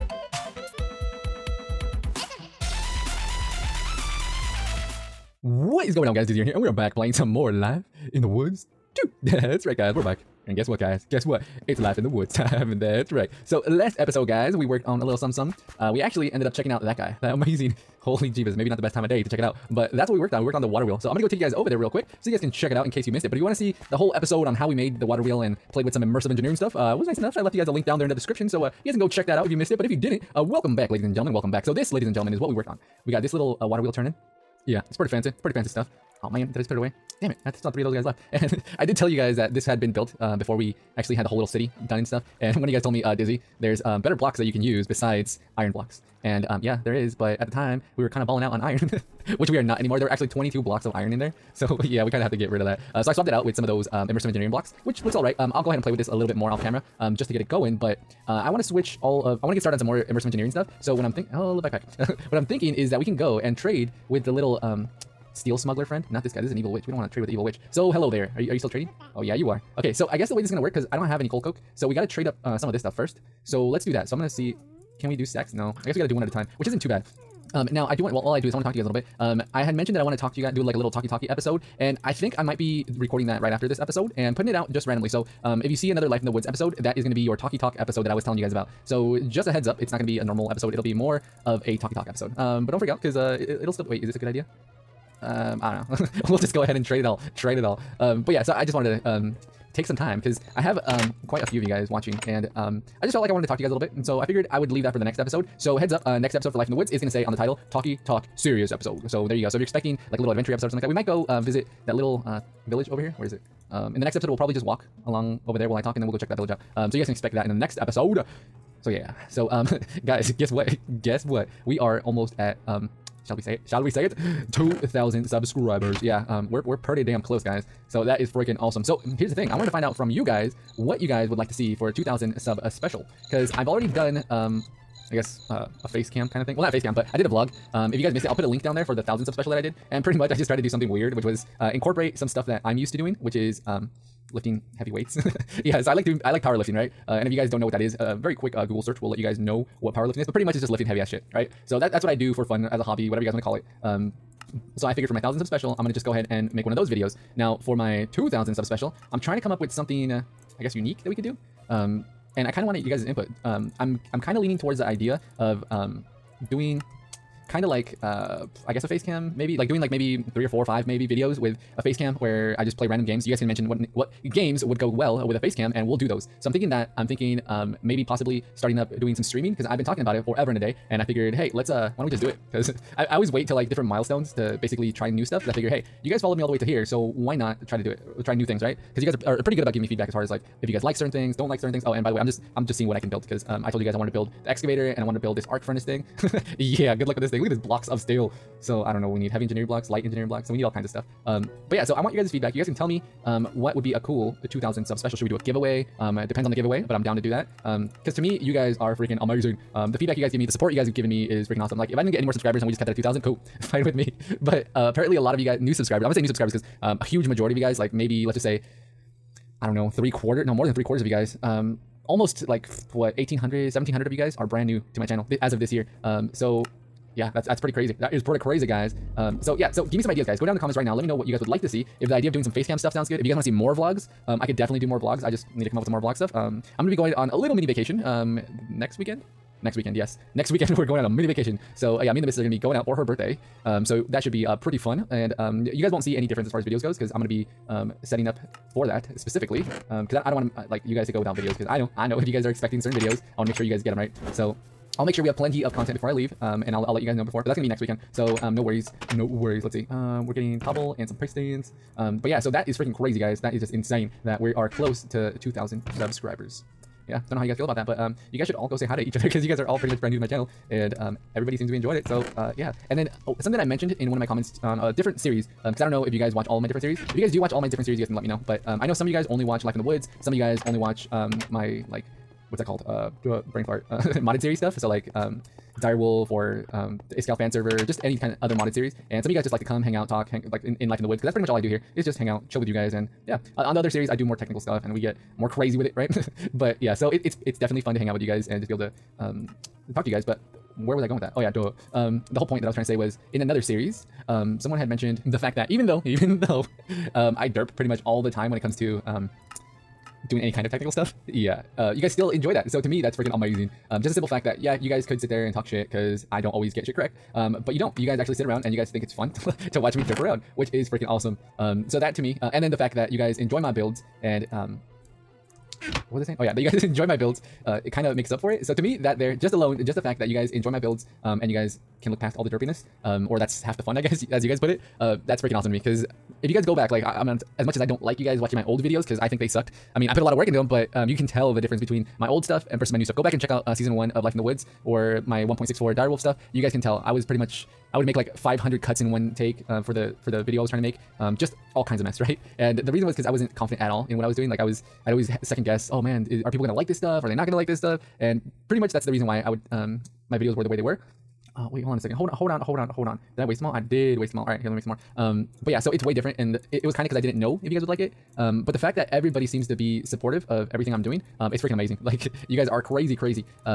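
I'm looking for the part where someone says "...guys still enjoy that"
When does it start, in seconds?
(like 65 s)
312 s.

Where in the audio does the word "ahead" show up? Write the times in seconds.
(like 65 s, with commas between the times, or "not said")
55 s, 96 s, 156 s.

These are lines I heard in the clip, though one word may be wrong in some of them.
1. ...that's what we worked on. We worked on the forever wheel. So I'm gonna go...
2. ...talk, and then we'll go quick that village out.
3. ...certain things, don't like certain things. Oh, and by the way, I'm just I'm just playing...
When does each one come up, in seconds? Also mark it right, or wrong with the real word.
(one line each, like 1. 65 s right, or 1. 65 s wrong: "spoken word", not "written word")
1. 19 s wrong: "water", not "forever"
2. 115 s wrong: "check", not "quick"
3. 190 s wrong: "seeing", not "playing".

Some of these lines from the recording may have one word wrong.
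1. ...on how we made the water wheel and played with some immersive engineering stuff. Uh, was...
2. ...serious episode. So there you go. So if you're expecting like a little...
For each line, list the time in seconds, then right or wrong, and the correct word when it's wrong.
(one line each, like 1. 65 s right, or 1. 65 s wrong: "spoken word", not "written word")
1. 24 s right
2. 108 s right.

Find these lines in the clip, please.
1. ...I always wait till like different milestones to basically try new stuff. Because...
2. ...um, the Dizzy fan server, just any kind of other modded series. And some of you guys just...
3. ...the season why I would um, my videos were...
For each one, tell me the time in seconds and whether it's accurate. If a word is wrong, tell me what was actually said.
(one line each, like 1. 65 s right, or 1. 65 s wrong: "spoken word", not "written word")
1. 183 s right
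2. 286 s wrong: "Iskall", not "Dizzy"
3. 359 s wrong: "reason", not "season".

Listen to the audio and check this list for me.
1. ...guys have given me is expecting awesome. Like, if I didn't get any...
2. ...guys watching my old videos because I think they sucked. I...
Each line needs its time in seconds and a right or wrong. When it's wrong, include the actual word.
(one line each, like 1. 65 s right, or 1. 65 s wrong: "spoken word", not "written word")
1. 210 s wrong: "freaking", not "expecting"
2. 338 s right.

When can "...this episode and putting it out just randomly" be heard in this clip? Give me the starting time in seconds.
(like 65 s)
83 s.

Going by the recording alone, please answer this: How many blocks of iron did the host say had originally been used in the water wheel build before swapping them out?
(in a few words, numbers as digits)
22.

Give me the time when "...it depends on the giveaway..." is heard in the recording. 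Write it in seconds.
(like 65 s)
206 s.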